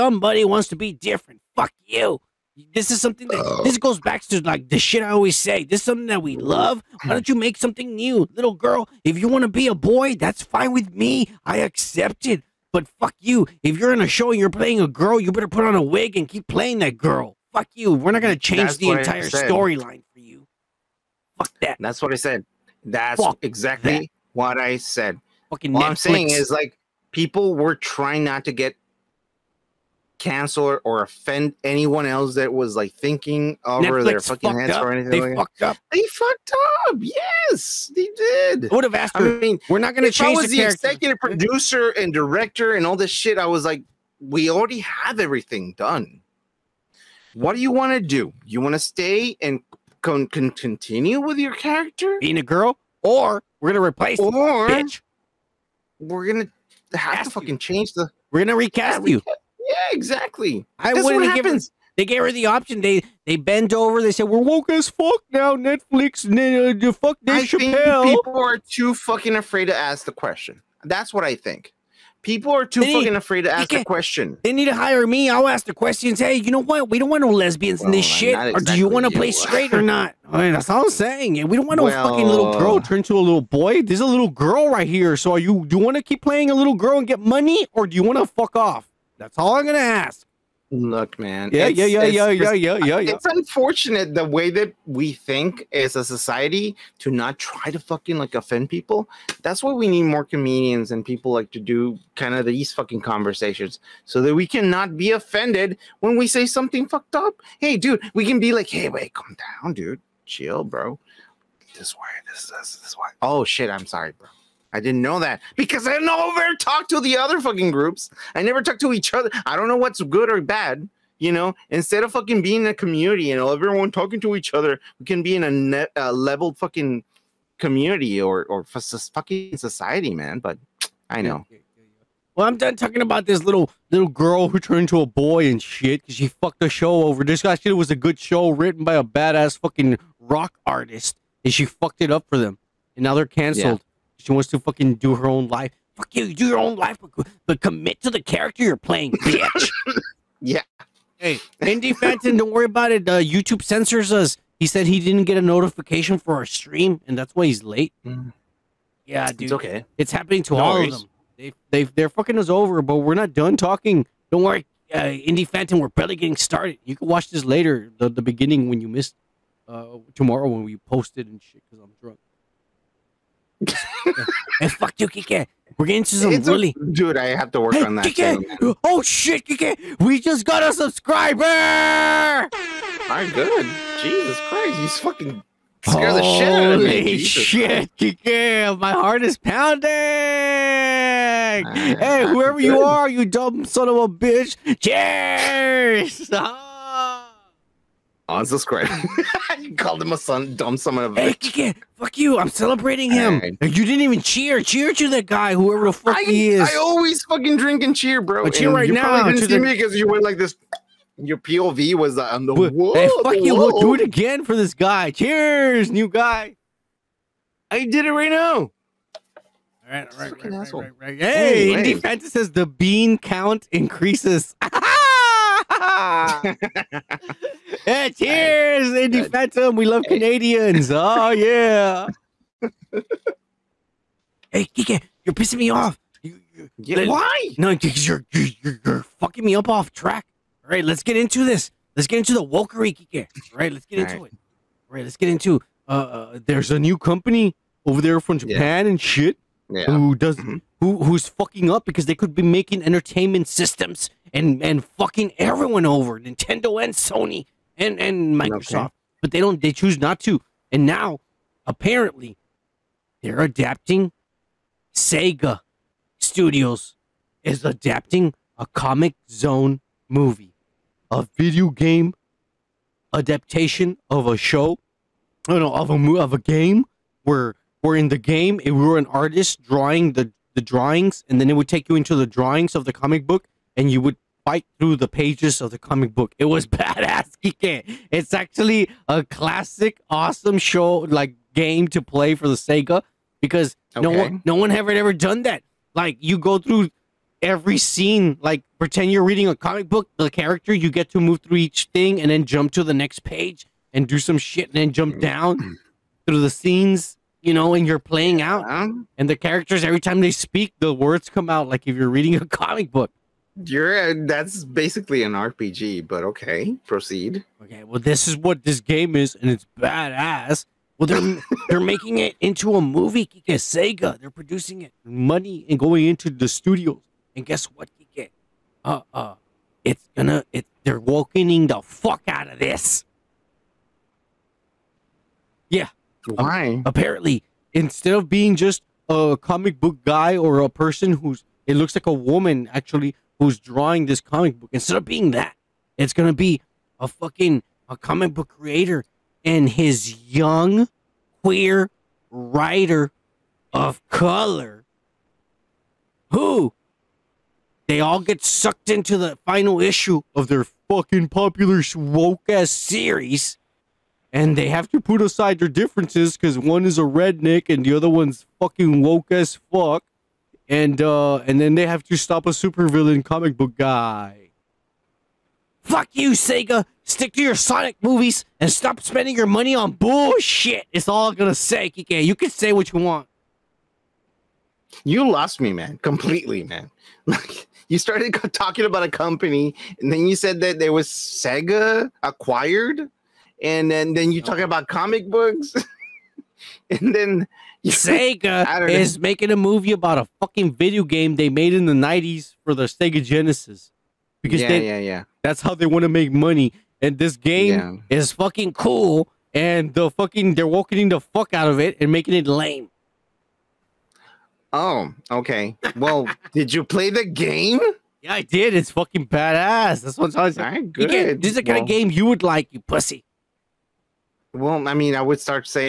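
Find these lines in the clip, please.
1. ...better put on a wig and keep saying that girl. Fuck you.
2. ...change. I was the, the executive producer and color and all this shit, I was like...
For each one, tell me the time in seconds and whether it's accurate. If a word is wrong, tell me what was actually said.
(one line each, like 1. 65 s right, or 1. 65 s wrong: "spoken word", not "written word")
1. 15 s wrong: "playing", not "saying"
2. 40 s wrong: "director", not "color".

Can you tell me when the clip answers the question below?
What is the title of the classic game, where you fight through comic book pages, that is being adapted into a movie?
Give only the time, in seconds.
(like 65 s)
268 s.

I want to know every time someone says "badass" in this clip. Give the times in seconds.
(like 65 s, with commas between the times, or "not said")
139 s, 286 s, 319 s, 419 s.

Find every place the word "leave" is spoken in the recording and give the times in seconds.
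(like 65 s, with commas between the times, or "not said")
not said.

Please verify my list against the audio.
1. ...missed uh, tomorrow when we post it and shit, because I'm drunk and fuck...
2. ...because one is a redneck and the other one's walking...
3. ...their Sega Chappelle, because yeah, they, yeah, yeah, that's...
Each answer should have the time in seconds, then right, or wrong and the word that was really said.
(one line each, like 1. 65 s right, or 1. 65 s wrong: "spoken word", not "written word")
1. 168 s right
2. 366 s wrong: "fucking", not "walking"
3. 402 s wrong: "Genesis", not "Chappelle".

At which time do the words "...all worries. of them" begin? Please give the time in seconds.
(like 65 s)
160 s.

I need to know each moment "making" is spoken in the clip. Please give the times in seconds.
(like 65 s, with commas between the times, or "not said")
252 s, 321 s, 399 s, 412 s.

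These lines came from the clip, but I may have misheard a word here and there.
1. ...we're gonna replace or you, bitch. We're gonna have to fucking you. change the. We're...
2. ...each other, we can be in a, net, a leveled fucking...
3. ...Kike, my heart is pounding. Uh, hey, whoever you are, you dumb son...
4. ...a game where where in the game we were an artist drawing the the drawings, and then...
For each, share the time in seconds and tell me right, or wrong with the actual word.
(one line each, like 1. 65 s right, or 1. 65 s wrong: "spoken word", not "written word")
1. 53 s right
2. 124 s right
3. 187 s right
4. 276 s right.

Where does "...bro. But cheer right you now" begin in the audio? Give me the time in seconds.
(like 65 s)
208 s.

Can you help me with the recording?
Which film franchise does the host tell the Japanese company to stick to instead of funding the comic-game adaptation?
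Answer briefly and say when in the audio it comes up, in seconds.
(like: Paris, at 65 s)
Sonic movies, at 377 s.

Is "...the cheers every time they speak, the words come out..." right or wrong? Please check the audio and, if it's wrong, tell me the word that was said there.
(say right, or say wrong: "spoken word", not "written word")
wrong: "characters", not "cheers".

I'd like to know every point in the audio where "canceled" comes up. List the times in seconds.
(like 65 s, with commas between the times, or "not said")
30 s, 143 s.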